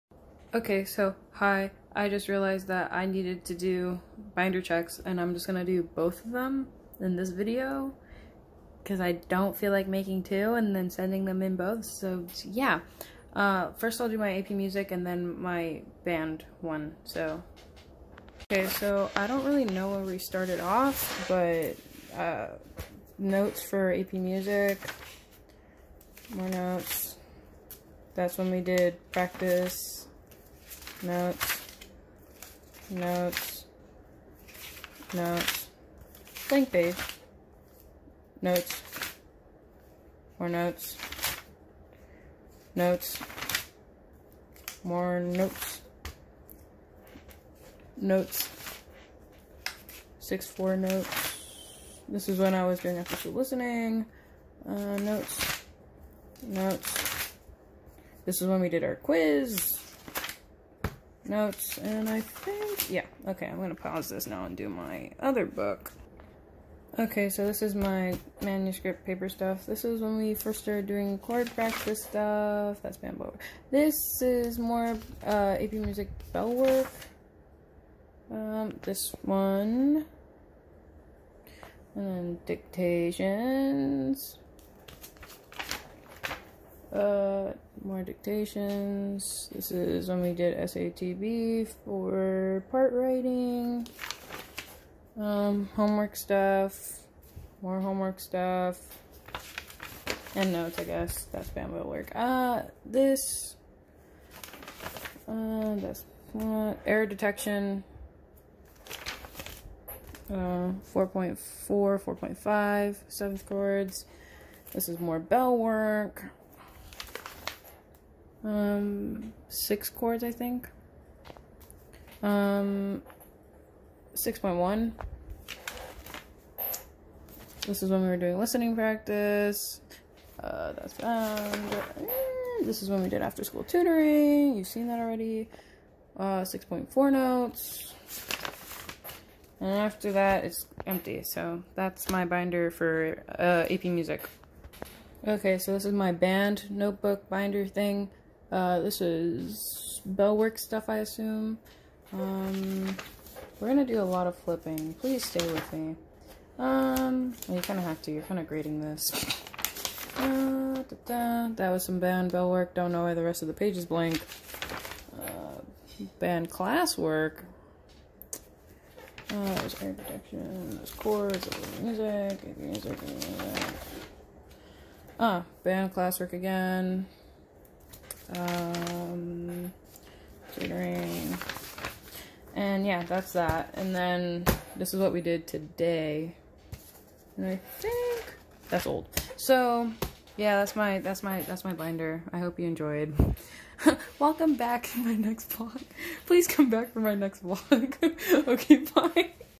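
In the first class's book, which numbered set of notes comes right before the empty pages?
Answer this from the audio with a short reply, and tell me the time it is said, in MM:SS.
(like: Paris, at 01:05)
6.4, at 02:16.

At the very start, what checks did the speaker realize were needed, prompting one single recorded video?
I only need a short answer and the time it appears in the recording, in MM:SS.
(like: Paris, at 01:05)
binder checks, at 00:04.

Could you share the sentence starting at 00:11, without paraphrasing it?
So yeah, uh, first I'll do my AP music and then my band one.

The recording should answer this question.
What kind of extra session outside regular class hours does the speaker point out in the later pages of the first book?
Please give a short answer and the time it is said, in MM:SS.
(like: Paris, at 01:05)
After school tutoring, at 02:13.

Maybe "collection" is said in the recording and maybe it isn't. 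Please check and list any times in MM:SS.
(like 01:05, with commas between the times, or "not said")
not said.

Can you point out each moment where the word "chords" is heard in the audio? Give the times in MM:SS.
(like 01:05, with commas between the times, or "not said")
01:11, 01:53, 01:59, 02:50.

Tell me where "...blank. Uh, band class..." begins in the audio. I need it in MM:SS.
02:43.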